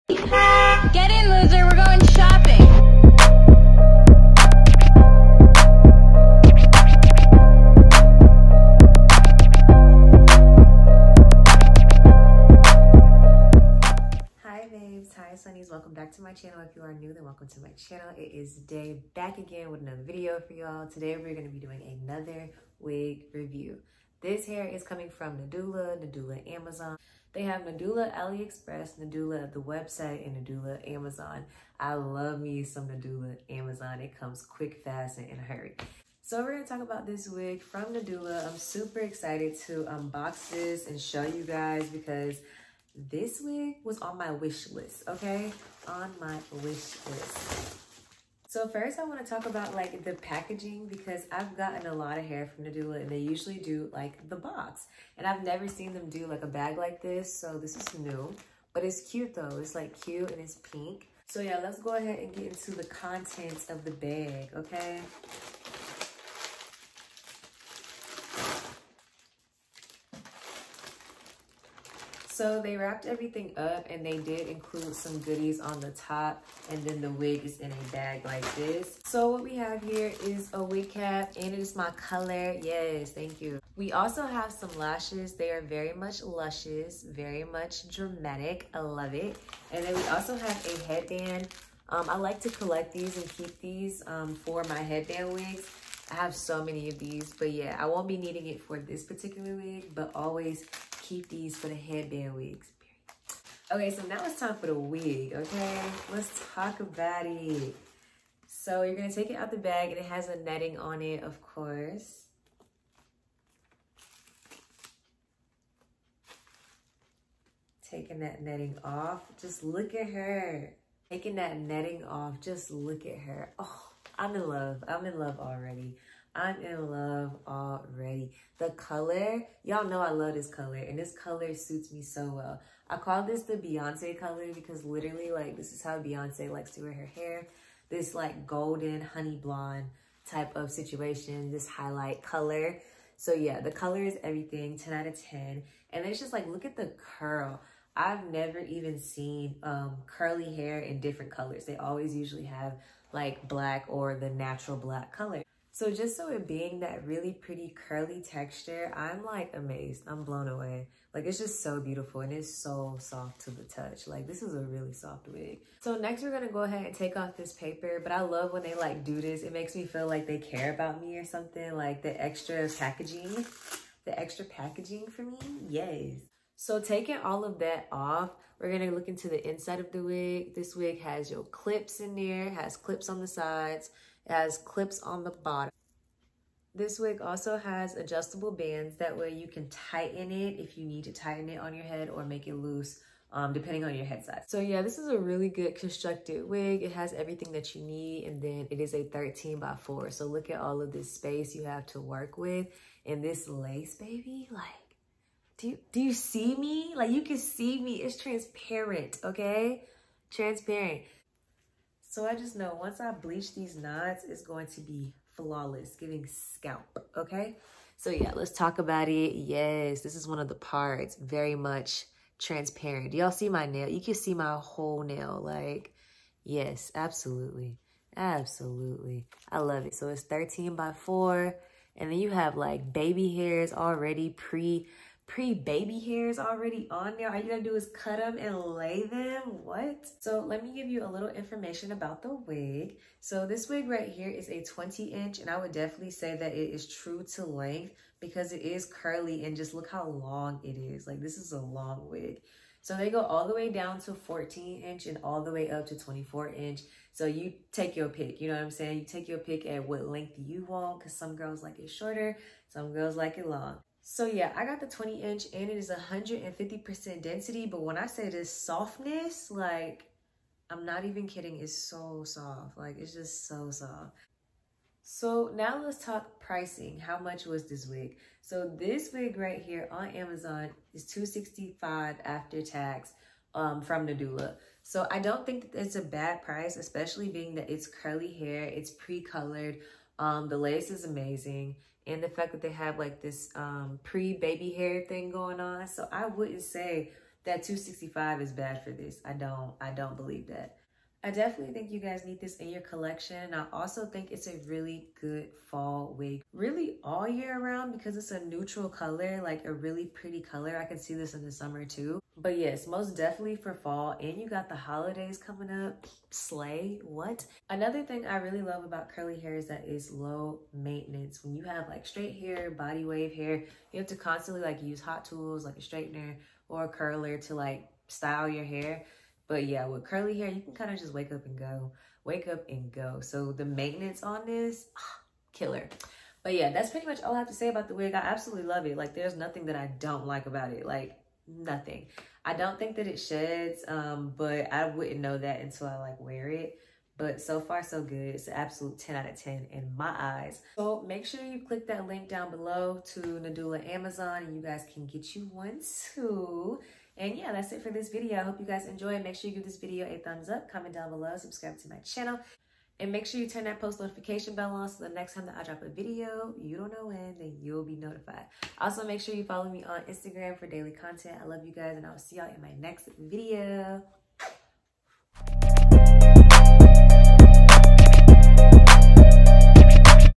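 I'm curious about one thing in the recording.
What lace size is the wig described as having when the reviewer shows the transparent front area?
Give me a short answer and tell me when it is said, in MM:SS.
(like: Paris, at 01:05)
13 by 4, at 03:19.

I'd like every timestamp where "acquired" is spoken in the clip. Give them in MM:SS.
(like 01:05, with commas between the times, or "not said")
not said.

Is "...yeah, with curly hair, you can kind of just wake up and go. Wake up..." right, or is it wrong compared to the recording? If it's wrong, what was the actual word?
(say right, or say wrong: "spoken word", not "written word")
right.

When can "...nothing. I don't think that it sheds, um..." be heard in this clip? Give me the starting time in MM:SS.
05:41.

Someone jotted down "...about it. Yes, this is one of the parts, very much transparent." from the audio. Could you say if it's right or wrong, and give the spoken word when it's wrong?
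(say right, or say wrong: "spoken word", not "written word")
right.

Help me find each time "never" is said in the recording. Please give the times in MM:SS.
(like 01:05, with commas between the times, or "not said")
00:55, 02:28.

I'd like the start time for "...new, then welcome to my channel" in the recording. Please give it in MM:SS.
00:16.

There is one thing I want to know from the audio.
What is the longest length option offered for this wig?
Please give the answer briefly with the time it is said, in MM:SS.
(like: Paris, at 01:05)
24 inch, at 04:15.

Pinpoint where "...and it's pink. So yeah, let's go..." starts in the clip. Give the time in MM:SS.
01:00.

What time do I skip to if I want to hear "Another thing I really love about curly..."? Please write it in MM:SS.
05:17.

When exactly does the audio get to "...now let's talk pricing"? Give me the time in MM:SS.
04:35.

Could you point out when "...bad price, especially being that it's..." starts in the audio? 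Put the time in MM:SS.
04:46.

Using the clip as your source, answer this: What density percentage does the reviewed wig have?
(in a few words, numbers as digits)
150%.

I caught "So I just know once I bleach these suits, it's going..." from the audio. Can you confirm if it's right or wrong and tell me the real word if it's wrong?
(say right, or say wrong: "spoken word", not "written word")
wrong: "knots", not "suits".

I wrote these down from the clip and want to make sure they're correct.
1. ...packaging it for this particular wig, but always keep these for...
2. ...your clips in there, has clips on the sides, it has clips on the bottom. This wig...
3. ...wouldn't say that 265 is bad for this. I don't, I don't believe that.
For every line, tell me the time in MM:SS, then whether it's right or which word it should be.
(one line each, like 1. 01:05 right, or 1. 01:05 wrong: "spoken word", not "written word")
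1. 01:38 wrong: "needing", not "packaging"
2. 03:01 right
3. 04:56 right.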